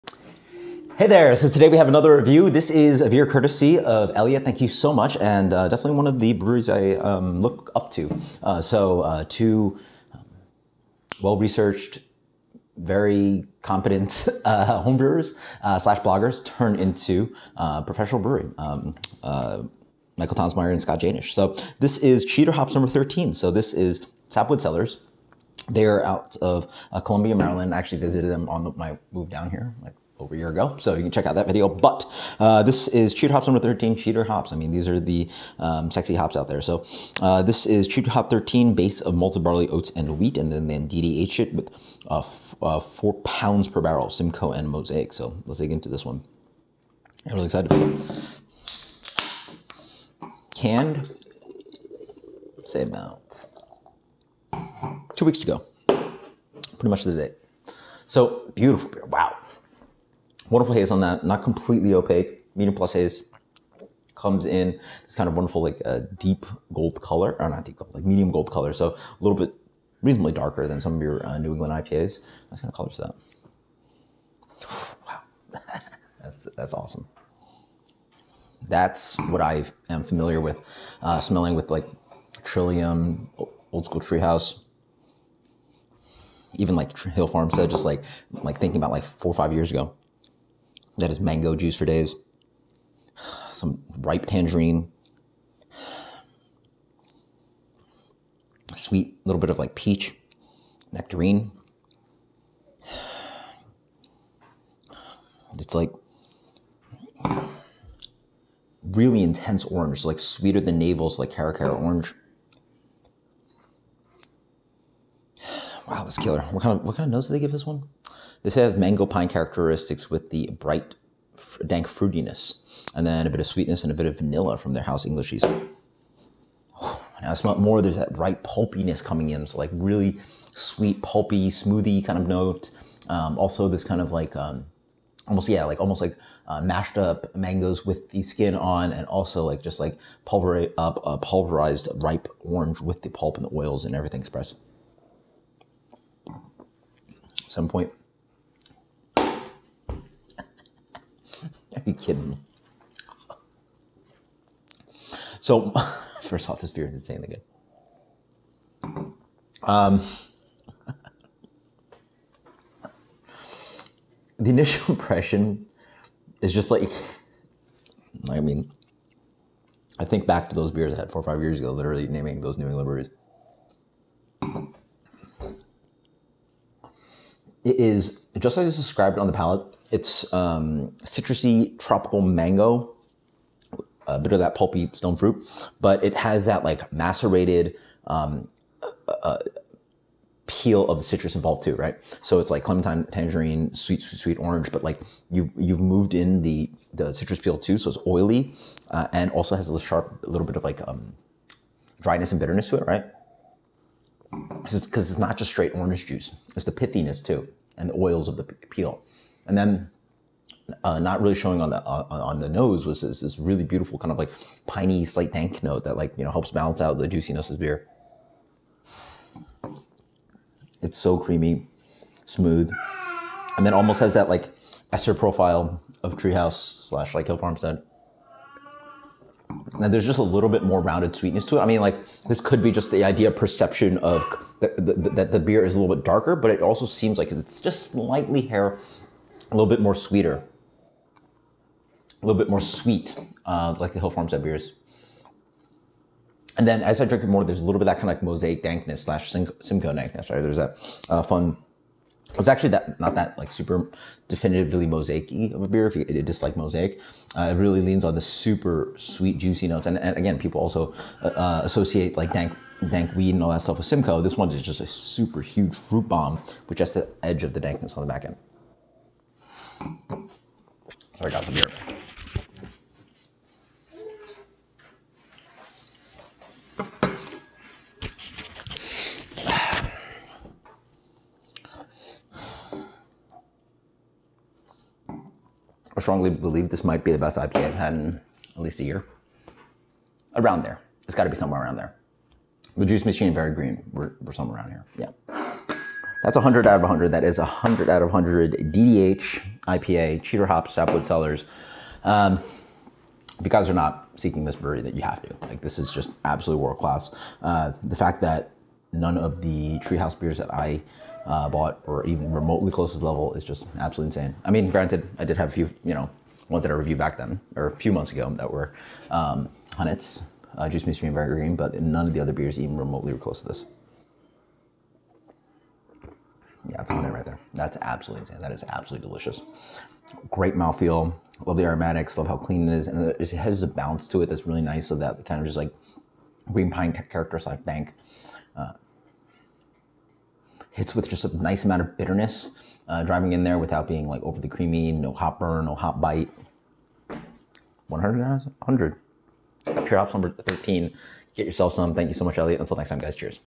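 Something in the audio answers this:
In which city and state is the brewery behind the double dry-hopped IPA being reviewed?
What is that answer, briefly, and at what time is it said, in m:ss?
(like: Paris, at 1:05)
Columbia, Maryland, at 0:27.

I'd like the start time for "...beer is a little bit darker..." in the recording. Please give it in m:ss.
3:55.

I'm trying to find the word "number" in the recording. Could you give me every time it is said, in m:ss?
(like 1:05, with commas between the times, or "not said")
0:22, 0:33, 5:50.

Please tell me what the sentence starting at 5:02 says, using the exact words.
Um, if you guys are not seeking this brewery, that you have to.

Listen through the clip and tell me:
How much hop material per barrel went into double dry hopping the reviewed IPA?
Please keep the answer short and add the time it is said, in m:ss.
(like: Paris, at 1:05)
4 pounds per barrel, at 0:42.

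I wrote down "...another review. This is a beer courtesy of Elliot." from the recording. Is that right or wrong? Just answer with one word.
right.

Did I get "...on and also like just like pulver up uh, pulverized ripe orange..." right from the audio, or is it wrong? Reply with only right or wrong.
right.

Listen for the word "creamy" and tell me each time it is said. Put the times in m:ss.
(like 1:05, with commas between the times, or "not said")
3:41, 5:44.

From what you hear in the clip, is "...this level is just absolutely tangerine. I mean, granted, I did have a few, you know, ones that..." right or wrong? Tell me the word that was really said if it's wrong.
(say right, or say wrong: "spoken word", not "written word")
wrong: "insane", not "tangerine".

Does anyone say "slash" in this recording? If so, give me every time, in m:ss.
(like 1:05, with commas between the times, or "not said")
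0:15, 3:46, 4:09, 5:37.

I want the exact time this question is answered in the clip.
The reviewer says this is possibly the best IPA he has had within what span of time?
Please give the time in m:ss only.
4:48.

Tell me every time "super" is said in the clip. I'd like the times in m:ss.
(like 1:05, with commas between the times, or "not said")
4:13, 4:18, 4:24.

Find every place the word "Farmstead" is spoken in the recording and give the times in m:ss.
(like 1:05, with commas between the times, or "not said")
1:27, 3:47, 4:04.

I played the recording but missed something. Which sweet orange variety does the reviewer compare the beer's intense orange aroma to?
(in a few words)
Caracara orange.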